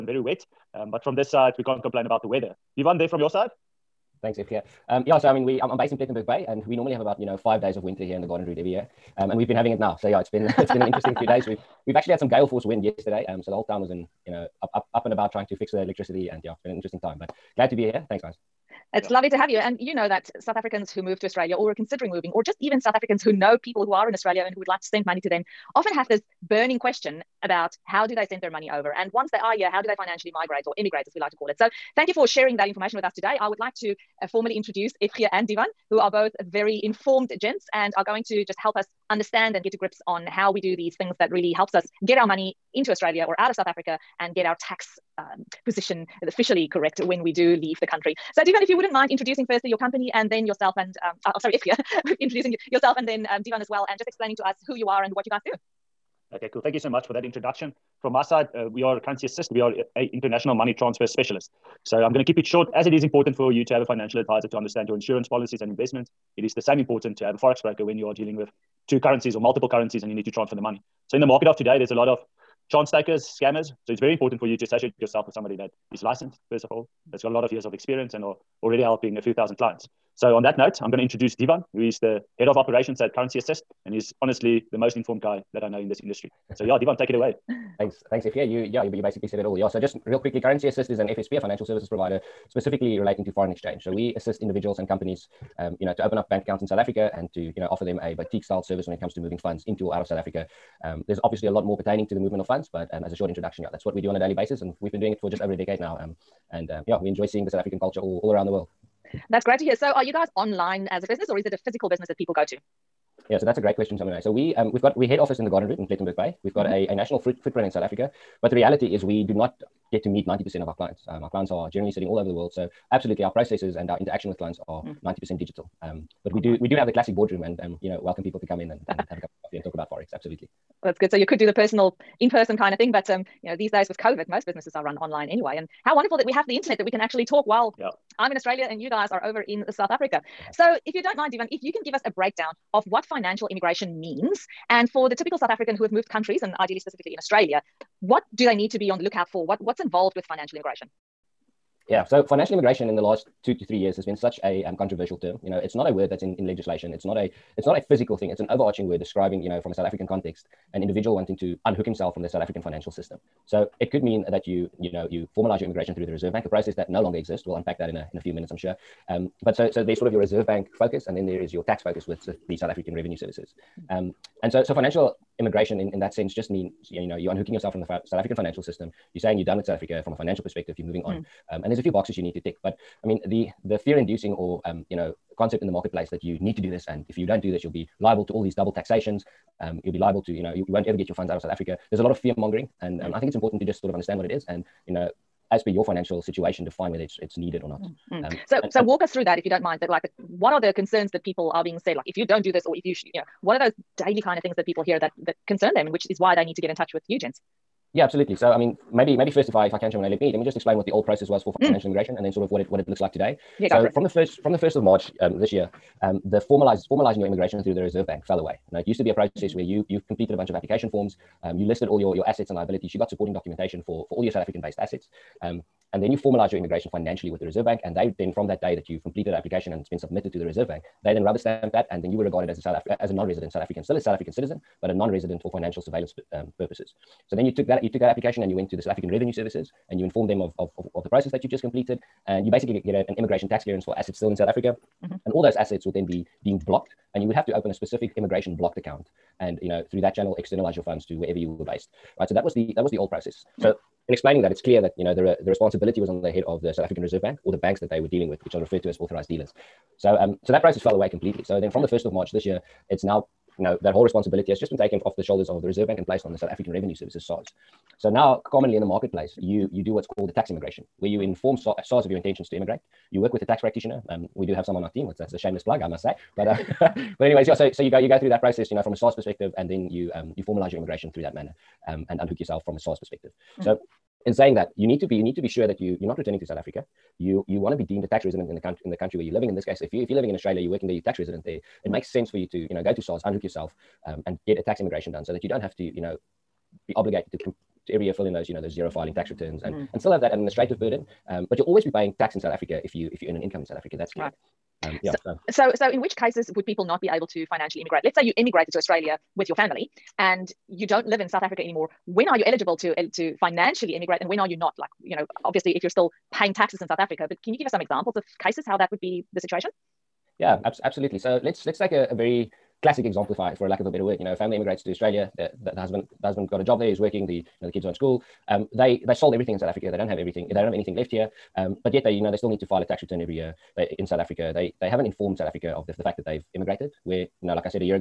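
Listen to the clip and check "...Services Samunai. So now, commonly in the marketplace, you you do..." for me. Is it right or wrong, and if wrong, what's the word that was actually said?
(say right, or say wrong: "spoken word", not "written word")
wrong: "SARS", not "Samunai".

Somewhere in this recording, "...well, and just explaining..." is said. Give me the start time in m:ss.
0:53.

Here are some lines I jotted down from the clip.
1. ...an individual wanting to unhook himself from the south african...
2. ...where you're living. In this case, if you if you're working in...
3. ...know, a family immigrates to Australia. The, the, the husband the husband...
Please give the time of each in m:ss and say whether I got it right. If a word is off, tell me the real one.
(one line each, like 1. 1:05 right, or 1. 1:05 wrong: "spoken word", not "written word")
1. 2:40 right
2. 4:49 wrong: "living", not "working"
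3. 5:24 right.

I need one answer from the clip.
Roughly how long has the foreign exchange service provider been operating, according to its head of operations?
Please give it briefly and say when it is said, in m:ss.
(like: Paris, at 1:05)
just over a decade, at 1:45.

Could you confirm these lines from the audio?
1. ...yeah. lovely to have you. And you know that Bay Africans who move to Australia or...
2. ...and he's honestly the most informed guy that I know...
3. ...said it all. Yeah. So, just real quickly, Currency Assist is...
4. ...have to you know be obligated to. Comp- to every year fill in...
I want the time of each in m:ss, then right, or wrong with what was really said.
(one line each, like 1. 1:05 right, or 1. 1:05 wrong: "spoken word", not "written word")
1. 0:19 wrong: "South", not "Bay"
2. 1:23 right
3. 1:29 right
4. 4:55 right.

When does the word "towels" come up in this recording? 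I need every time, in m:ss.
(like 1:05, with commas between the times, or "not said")
not said.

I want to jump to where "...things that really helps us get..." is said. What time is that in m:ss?
0:40.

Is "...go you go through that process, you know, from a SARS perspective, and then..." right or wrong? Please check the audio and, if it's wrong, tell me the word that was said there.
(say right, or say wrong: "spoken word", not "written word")
right.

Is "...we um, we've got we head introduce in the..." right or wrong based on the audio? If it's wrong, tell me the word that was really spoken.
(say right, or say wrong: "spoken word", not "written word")
wrong: "office", not "introduce".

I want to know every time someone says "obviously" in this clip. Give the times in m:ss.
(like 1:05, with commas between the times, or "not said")
1:41, 5:15.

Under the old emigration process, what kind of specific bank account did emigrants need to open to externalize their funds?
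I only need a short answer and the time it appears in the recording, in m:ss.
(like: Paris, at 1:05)
immigration blocked account, at 4:08.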